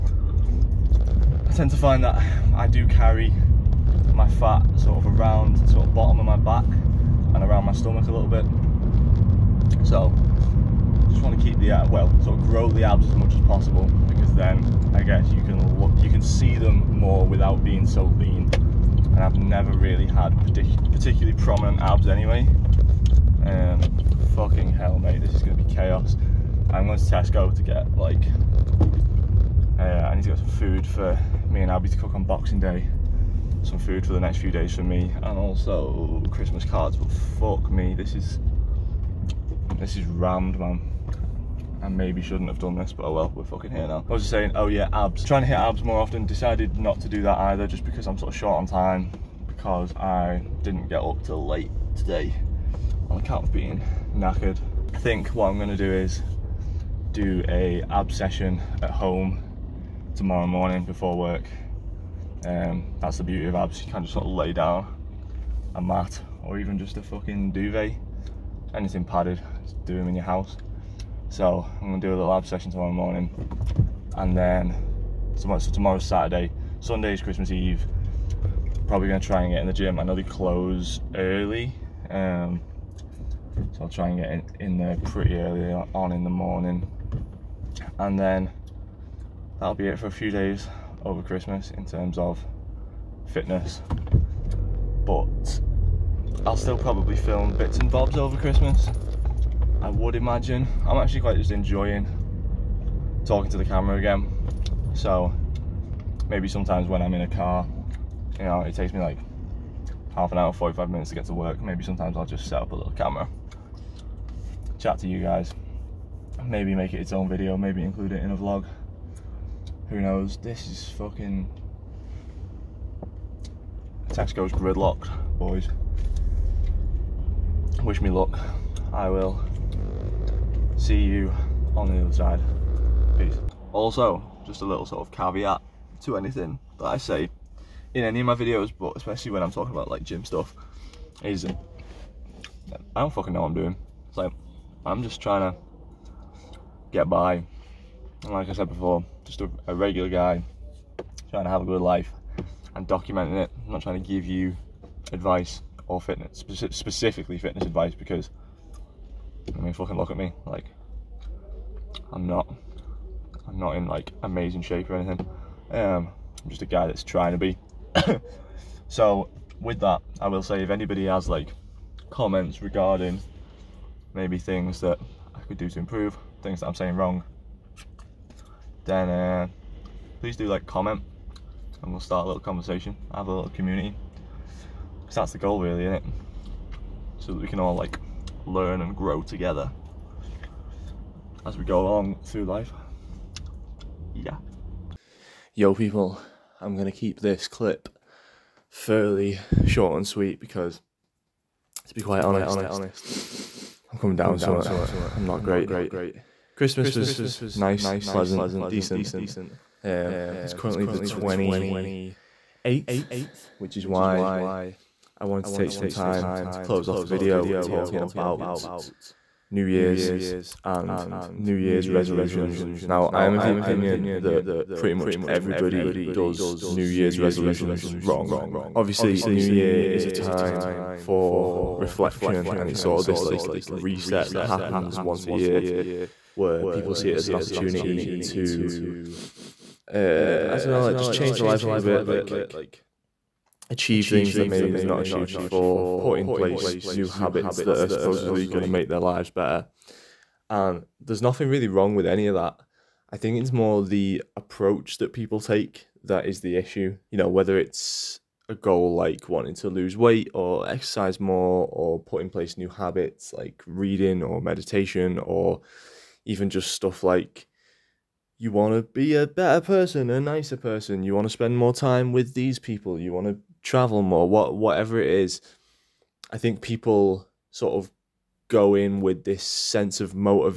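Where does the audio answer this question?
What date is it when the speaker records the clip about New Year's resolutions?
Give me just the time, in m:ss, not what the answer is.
3:30.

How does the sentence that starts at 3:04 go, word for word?
Because that's the goal, really, isn't it?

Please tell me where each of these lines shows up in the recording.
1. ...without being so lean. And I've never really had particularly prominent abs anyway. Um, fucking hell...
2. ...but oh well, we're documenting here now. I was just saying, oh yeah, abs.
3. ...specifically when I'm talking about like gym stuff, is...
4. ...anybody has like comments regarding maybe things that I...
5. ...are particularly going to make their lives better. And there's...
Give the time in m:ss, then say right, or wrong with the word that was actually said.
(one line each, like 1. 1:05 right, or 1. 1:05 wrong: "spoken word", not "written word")
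1. 0:17 right
2. 0:42 wrong: "fucking", not "documenting"
3. 2:18 wrong: "especially", not "specifically"
4. 2:50 right
5. 4:07 wrong: "supposedly", not "particularly".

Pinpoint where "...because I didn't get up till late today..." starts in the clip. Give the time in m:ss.
0:49.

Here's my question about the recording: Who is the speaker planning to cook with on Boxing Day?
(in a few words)
Abby.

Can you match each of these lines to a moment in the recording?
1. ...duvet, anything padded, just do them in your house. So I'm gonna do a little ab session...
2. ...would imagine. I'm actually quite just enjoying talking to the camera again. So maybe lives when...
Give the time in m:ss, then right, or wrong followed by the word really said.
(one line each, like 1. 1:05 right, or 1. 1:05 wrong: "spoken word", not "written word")
1. 1:07 right
2. 1:39 wrong: "sometimes", not "lives".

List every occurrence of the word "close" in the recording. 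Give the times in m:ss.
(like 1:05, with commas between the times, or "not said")
1:20, 3:36.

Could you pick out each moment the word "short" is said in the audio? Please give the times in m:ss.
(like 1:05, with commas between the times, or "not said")
0:48, 3:19.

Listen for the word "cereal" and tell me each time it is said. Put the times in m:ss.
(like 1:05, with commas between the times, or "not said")
not said.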